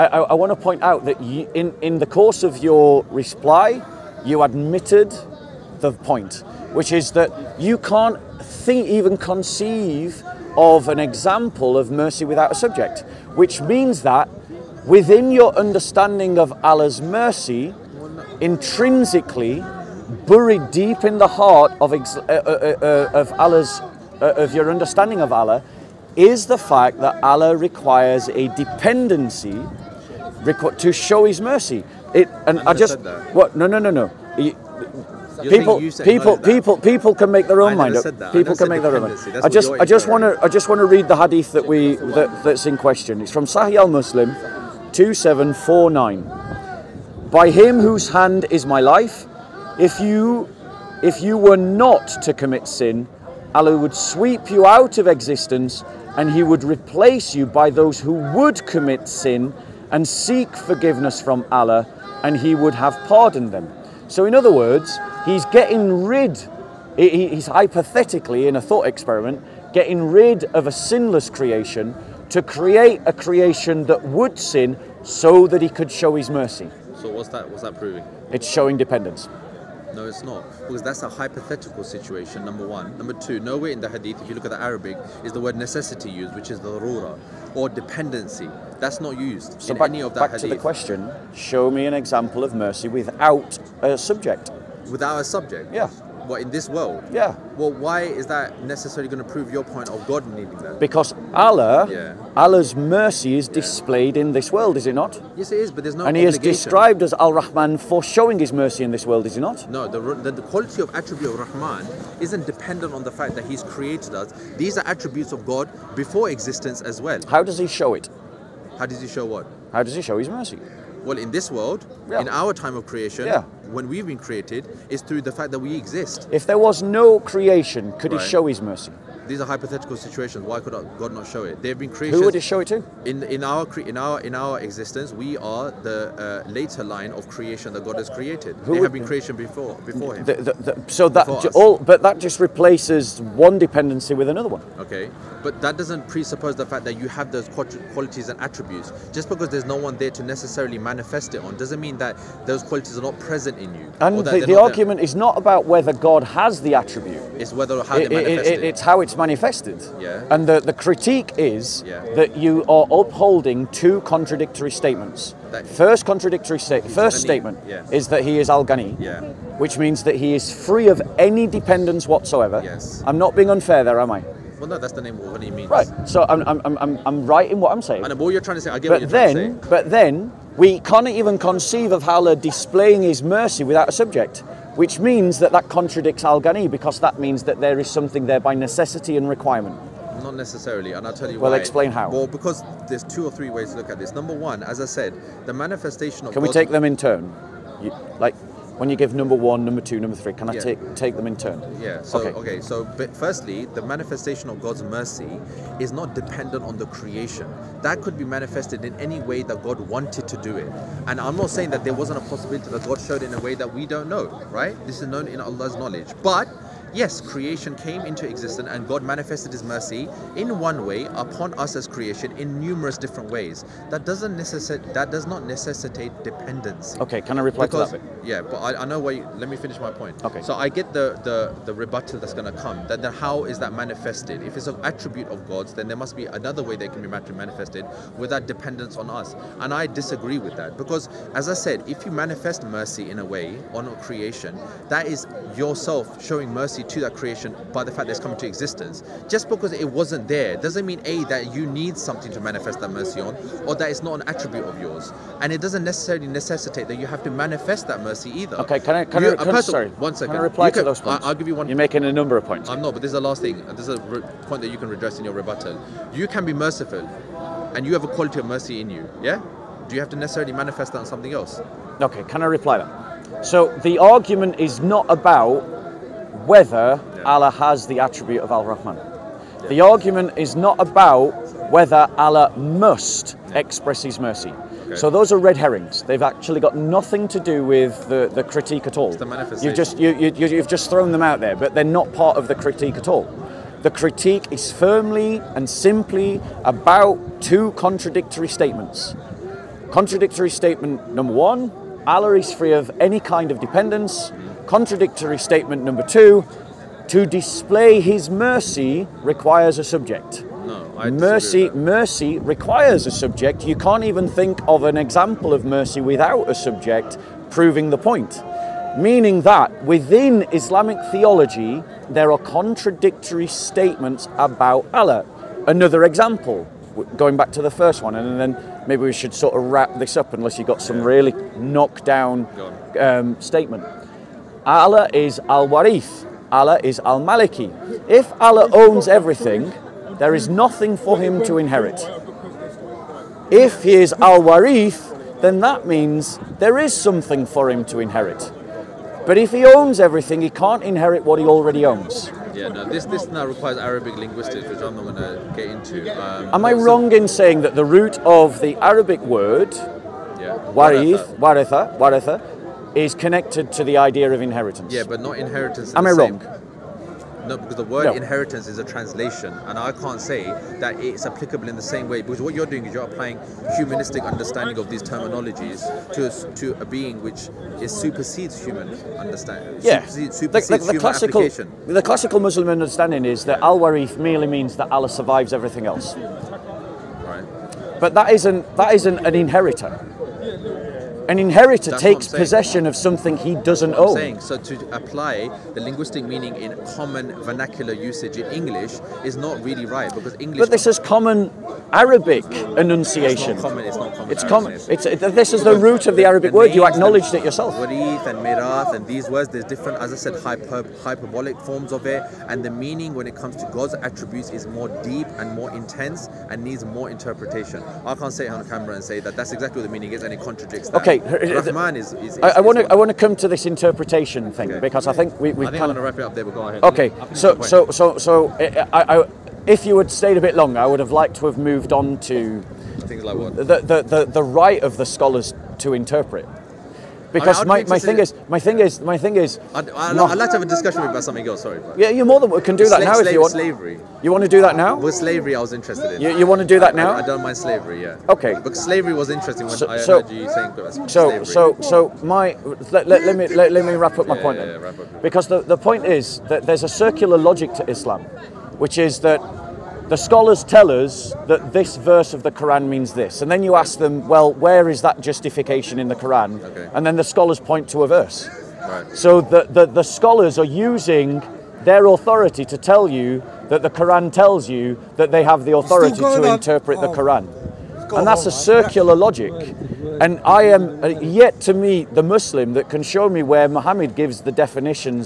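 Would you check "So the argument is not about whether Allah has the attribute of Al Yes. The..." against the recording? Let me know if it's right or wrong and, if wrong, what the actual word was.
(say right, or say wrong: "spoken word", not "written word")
wrong: "Rahman", not "Yes".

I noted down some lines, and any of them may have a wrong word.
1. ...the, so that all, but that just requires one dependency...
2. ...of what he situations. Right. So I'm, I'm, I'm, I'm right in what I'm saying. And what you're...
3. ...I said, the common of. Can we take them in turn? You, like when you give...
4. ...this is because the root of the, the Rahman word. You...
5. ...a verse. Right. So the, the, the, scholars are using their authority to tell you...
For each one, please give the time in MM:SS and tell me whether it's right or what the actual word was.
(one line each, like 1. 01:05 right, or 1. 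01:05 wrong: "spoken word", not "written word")
1. 02:20 wrong: "replaces", not "requires"
2. 02:55 wrong: "means", not "situations"
3. 03:14 wrong: "manifestation", not "common"
4. 06:45 wrong: "Arabic", not "Rahman"
5. 07:48 right.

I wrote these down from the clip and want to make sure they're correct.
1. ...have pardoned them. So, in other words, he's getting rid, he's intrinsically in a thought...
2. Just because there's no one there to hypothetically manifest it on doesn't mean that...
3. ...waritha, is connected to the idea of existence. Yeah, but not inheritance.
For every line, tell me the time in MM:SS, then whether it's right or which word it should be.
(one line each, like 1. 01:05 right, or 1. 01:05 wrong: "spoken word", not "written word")
1. 01:02 wrong: "hypothetically", not "intrinsically"
2. 02:29 wrong: "necessarily", not "hypothetically"
3. 06:01 wrong: "inheritance", not "existence".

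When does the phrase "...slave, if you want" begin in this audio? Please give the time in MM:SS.
07:23.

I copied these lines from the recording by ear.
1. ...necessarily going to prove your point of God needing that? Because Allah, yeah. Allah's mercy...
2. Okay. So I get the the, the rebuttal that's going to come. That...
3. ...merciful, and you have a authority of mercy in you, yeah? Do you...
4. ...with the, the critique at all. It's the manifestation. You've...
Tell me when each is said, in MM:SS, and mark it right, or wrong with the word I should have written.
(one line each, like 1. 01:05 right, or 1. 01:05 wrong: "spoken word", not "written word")
1. 01:38 right
2. 03:50 right
3. 04:26 wrong: "quality", not "authority"
4. 04:47 right.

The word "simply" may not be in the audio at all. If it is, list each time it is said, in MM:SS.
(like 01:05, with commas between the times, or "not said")
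04:55.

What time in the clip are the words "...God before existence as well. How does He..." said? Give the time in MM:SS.
01:55.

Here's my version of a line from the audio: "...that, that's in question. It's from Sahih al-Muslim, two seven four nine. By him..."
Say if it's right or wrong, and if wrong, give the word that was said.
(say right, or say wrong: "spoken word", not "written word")
right.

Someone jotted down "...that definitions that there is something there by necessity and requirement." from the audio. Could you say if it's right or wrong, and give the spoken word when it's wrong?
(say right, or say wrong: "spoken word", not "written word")
wrong: "means", not "definitions".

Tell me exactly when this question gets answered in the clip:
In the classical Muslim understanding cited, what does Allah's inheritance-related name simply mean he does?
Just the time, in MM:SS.
06:24.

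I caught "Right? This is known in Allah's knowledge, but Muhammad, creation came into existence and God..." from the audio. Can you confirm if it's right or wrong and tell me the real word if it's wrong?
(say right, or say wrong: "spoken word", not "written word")
wrong: "Yes", not "Muhammad".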